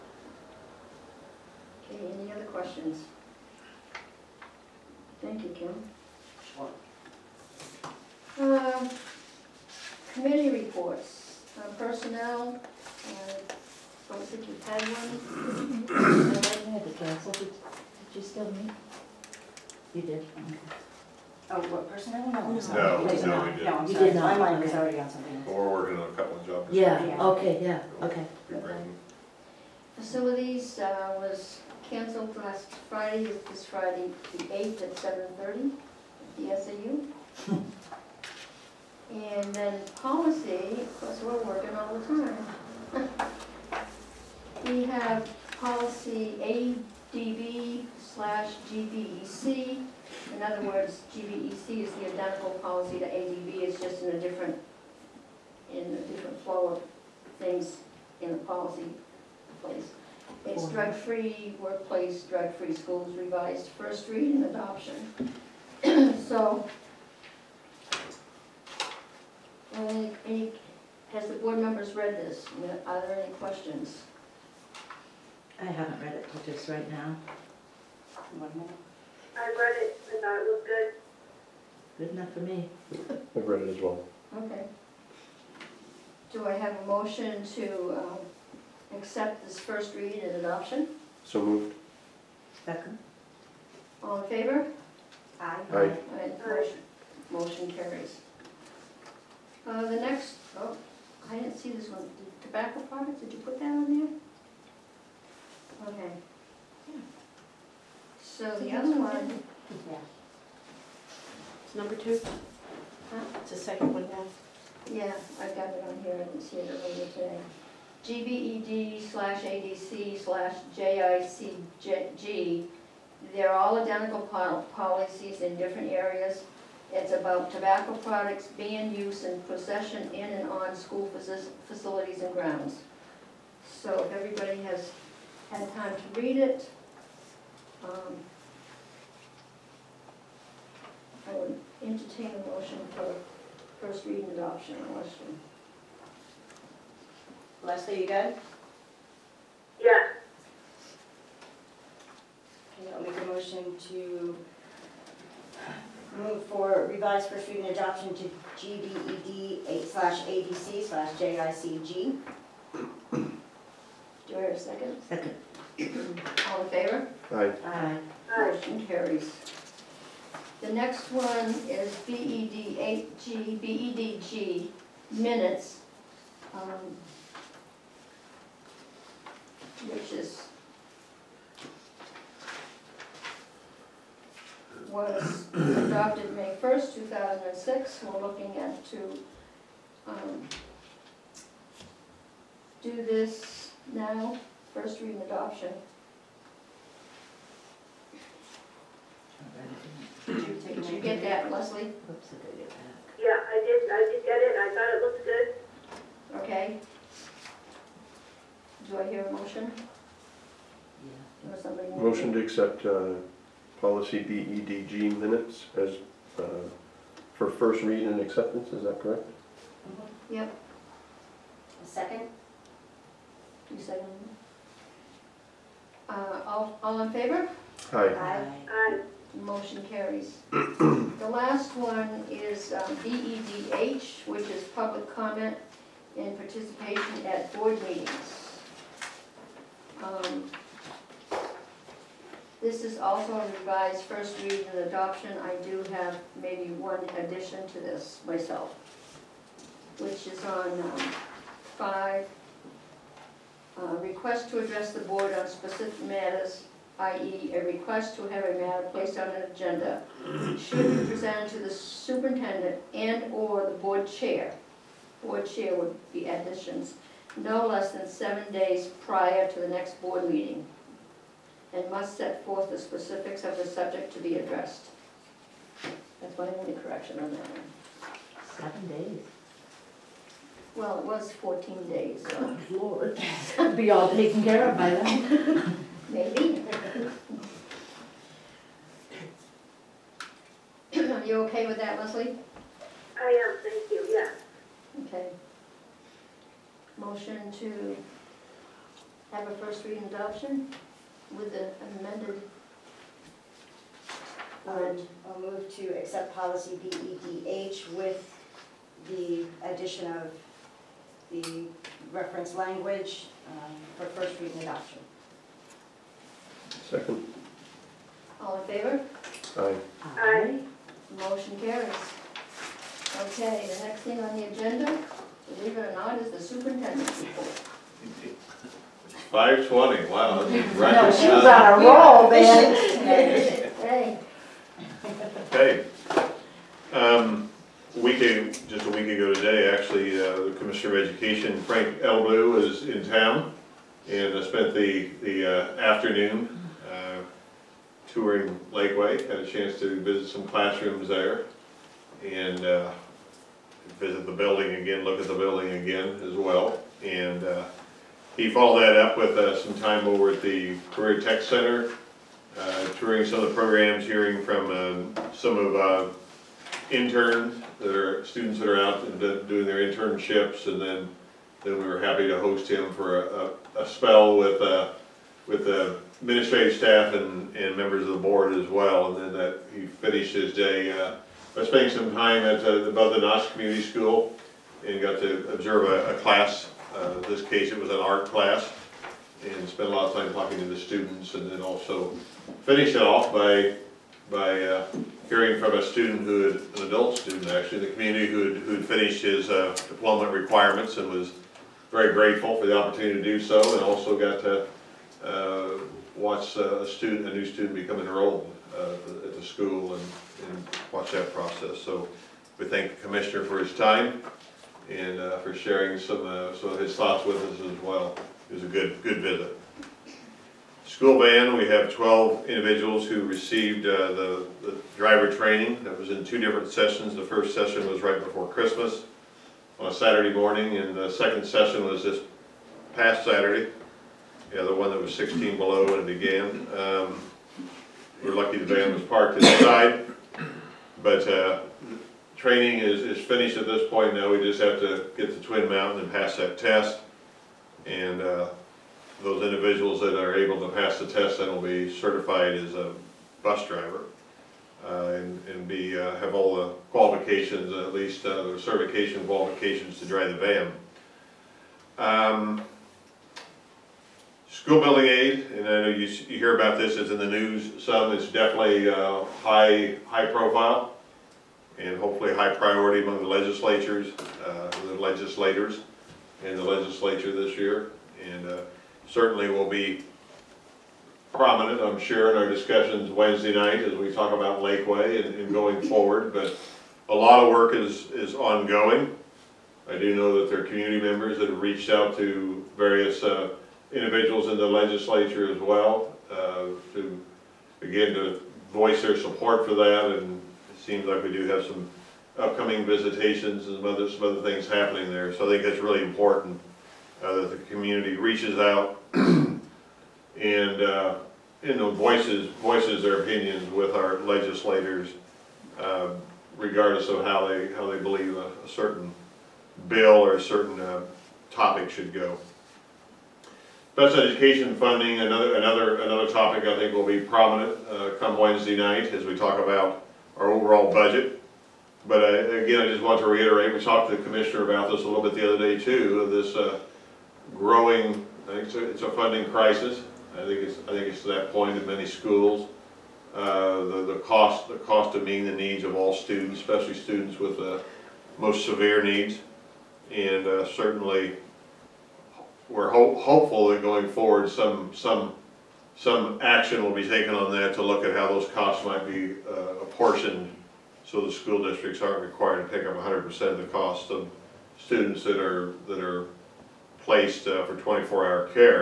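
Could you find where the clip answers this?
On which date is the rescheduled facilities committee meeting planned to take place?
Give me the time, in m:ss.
0:33.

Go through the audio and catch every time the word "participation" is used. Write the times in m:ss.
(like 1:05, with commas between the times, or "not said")
3:56.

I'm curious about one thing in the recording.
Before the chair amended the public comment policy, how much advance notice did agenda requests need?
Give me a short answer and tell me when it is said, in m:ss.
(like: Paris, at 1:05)
14 days, at 4:41.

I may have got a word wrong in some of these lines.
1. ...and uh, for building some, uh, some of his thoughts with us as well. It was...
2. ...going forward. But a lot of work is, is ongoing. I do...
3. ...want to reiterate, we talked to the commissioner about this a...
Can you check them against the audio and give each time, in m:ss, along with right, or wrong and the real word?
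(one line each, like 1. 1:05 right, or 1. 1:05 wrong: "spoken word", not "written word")
1. 6:54 wrong: "sharing", not "building"
2. 8:05 right
3. 8:53 right.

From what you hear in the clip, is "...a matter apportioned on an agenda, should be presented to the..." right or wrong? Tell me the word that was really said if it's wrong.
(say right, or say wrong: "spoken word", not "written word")
wrong: "placed", not "apportioned".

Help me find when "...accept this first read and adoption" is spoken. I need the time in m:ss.
1:28.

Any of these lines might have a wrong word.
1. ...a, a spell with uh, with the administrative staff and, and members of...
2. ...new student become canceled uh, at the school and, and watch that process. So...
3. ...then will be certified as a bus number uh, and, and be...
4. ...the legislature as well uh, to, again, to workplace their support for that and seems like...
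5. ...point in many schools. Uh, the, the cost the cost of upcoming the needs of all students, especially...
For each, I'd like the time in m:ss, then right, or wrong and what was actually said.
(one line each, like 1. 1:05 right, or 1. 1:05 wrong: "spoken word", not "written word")
1. 6:13 right
2. 6:47 wrong: "enrolled", not "canceled"
3. 7:31 wrong: "driver", not "number"
4. 8:14 wrong: "voice", not "workplace"
5. 9:01 wrong: "meeting", not "upcoming".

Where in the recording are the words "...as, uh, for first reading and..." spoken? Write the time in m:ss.
3:35.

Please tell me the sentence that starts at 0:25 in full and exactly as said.
we're working on a couple of jobs.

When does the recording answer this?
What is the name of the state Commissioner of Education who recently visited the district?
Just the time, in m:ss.
5:41.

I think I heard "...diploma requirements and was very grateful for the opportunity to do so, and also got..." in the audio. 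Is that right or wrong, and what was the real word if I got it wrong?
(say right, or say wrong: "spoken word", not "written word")
right.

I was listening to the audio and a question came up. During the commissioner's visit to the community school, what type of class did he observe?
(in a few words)
An art class.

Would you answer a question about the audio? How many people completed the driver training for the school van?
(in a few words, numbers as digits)
12.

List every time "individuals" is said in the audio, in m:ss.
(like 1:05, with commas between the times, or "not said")
7:02, 7:29, 8:13.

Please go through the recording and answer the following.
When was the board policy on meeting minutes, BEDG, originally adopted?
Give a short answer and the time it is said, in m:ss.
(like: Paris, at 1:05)
May 1, 2006, at 3:06.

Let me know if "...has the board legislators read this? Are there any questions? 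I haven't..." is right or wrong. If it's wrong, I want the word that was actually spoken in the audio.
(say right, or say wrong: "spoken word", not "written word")
wrong: "members", not "legislators".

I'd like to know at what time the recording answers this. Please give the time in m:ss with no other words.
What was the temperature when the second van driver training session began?
7:15.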